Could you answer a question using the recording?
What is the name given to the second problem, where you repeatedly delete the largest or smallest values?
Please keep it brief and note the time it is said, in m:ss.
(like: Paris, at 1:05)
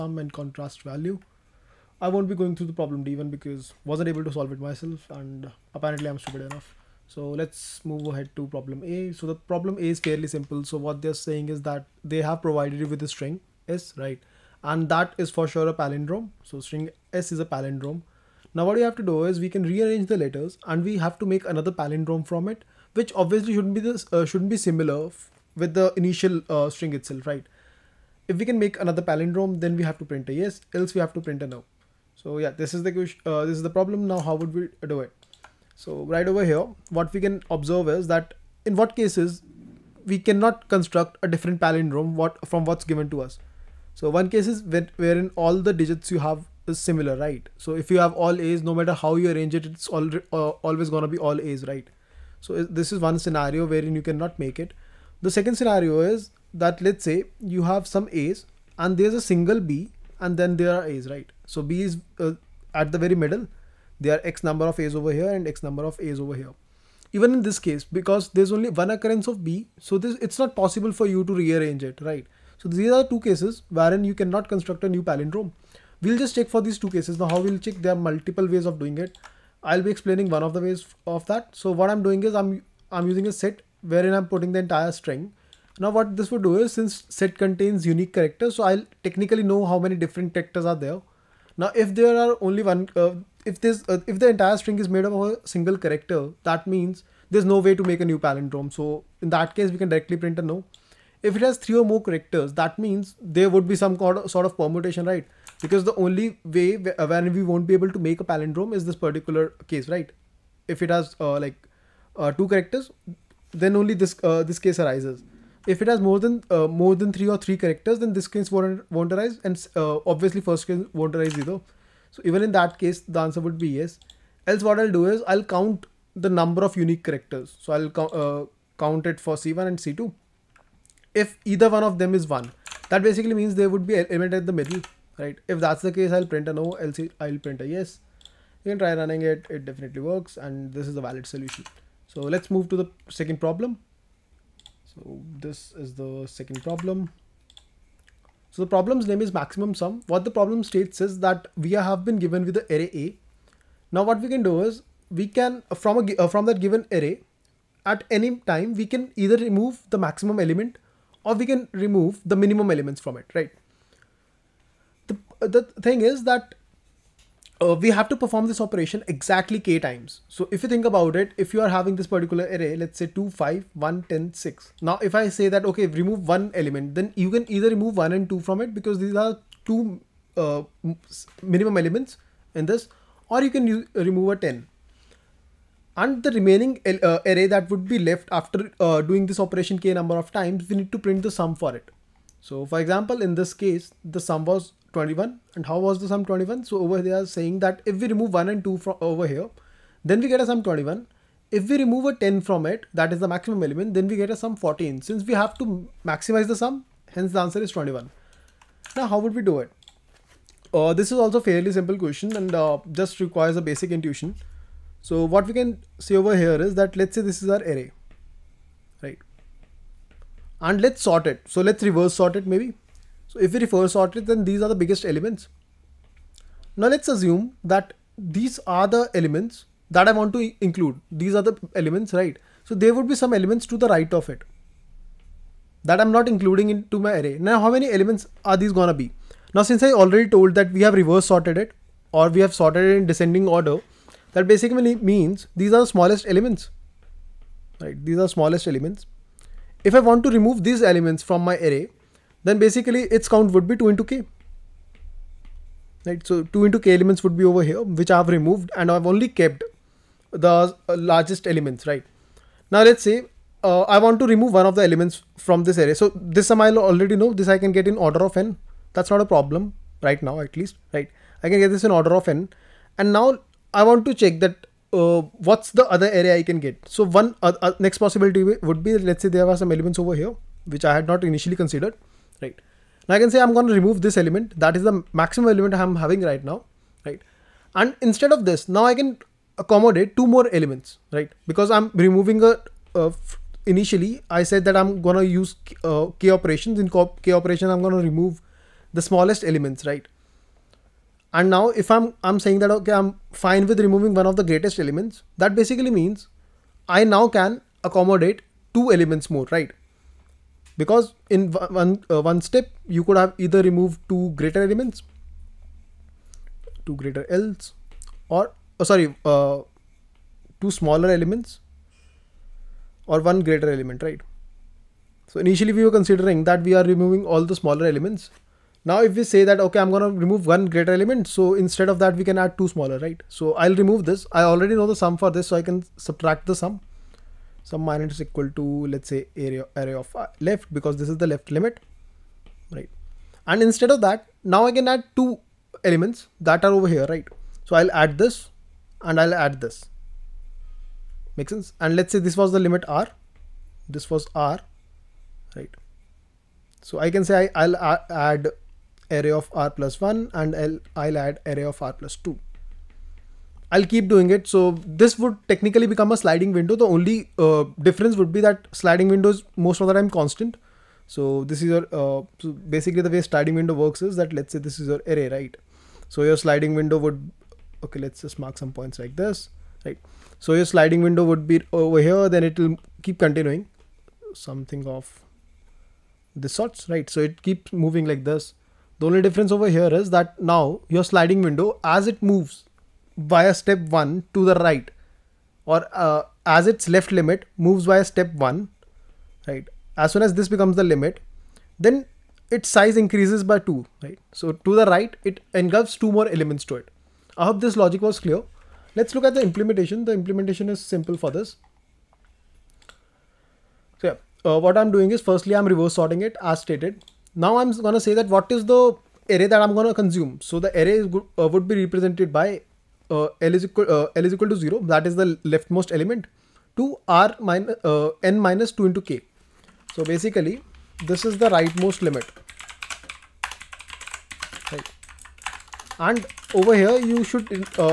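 maximum sum, at 2:29.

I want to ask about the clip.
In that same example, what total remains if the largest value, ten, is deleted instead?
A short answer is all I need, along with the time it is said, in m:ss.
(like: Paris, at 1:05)
14, at 3:24.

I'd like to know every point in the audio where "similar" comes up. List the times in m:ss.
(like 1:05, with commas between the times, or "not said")
0:24, 0:46.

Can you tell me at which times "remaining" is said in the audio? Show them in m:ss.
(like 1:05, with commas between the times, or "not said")
3:06.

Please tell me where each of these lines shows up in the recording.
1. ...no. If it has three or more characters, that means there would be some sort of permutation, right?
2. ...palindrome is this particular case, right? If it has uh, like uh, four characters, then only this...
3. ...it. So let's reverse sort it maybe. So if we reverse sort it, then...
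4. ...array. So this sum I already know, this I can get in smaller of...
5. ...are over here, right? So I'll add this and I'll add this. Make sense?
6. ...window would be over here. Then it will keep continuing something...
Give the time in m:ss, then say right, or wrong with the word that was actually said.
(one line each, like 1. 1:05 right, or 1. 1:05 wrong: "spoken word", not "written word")
1. 1:40 right
2. 1:48 wrong: "two", not "four"
3. 3:41 right
4. 4:25 wrong: "order", not "smaller"
5. 5:46 right
6. 6:21 right.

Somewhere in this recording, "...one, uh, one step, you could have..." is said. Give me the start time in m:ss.
5:11.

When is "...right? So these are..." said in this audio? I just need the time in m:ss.
1:12.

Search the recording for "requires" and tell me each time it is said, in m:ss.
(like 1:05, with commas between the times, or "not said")
3:33.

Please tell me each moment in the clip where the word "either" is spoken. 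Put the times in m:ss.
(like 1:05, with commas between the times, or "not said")
2:01, 2:11, 2:39, 2:57, 5:13.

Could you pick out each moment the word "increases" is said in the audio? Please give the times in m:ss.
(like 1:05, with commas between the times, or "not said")
6:42.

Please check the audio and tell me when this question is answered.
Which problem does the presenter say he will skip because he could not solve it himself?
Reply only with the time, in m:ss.
0:03.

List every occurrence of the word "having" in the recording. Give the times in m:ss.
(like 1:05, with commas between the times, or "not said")
2:51, 4:45.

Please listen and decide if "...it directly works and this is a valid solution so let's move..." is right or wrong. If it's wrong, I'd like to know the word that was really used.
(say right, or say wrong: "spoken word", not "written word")
wrong: "definitely", not "directly".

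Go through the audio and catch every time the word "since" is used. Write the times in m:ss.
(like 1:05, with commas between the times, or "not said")
1:26, 3:25, 3:59.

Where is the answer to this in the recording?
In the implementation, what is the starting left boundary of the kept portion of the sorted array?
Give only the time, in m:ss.
7:04.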